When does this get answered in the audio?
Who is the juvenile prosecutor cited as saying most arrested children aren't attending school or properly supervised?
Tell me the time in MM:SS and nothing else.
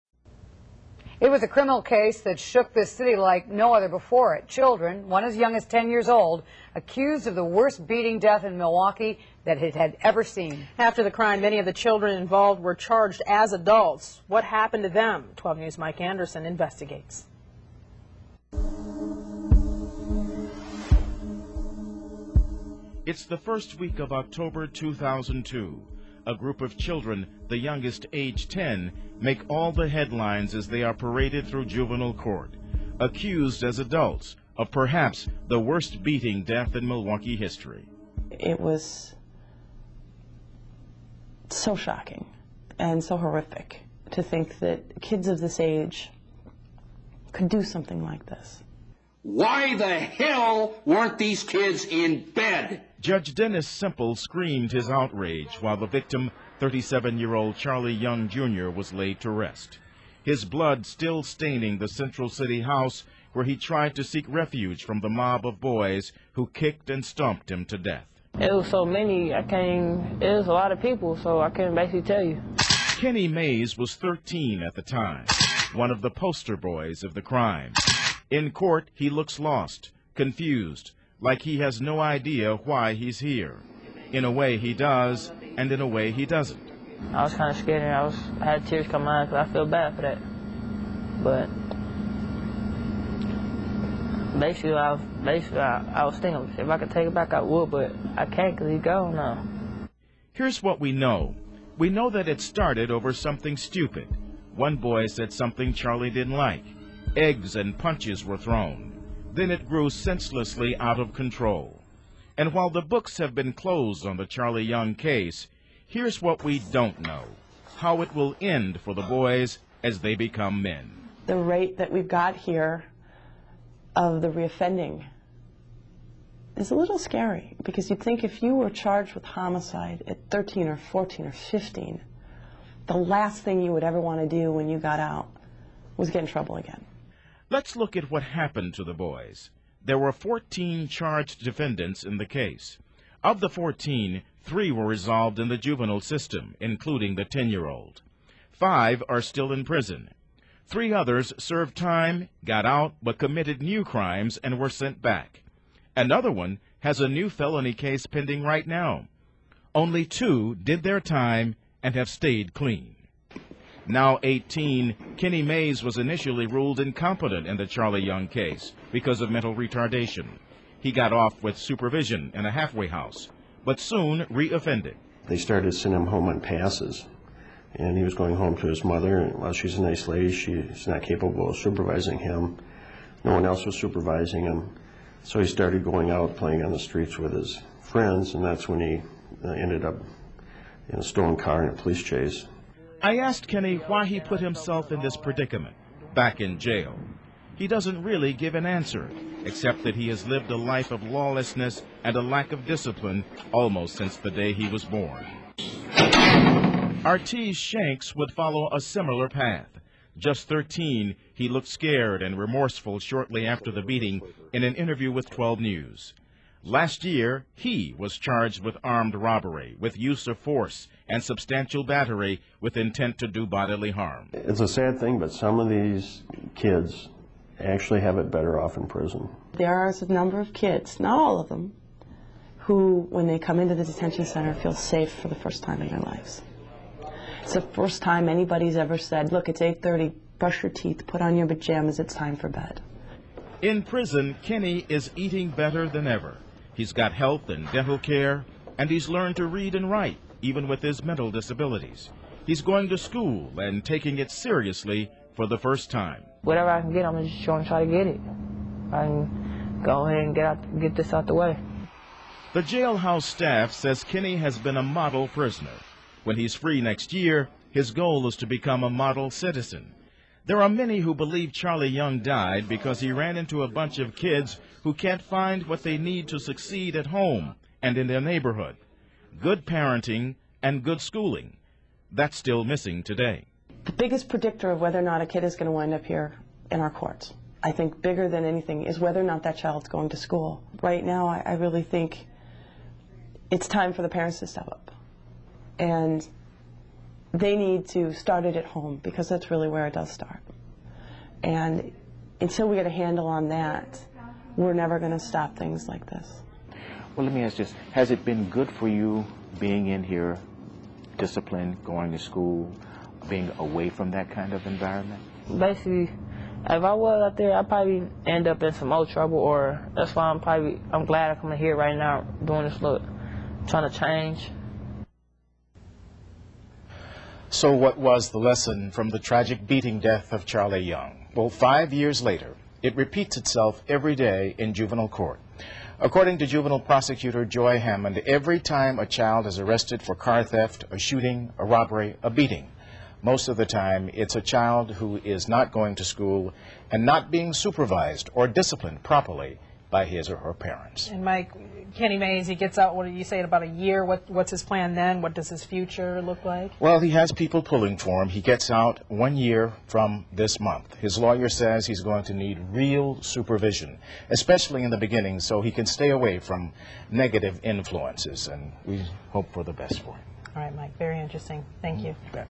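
05:37.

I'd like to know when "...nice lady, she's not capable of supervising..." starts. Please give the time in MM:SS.
02:59.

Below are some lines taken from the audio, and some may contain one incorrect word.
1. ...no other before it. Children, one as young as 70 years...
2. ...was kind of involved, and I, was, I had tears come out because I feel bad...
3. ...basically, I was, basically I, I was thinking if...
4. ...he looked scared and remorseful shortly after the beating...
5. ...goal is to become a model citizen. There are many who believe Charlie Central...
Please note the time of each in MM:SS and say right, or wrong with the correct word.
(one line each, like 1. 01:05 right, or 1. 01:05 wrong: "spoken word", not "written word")
1. 00:03 wrong: "10", not "70"
2. 01:27 wrong: "scared", not "involved"
3. 01:34 right
4. 03:31 right
5. 04:27 wrong: "Young", not "Central".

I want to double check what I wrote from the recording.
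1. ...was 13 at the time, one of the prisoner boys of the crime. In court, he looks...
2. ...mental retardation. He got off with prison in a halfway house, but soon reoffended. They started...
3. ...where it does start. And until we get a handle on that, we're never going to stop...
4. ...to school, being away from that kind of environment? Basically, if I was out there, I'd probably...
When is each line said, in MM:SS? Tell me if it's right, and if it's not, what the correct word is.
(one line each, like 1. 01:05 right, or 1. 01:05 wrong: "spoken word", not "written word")
1. 01:13 wrong: "poster", not "prisoner"
2. 02:49 wrong: "supervision", not "prison"
3. 04:59 right
4. 05:12 right.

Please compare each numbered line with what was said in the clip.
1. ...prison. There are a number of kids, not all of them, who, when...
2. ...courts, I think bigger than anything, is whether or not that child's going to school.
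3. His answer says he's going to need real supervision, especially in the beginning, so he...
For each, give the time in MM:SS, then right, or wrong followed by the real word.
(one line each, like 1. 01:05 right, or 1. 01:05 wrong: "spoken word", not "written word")
1. 03:48 right
2. 04:46 right
3. 06:00 wrong: "lawyer", not "answer".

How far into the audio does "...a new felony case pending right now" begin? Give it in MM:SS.
02:37.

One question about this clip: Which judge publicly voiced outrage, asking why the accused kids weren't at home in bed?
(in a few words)
Dennis Cimpl.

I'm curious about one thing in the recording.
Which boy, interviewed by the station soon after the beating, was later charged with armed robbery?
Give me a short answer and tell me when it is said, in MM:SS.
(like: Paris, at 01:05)
Artie Shanks, at 03:27.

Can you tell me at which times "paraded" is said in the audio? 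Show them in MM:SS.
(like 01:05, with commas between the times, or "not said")
00:30.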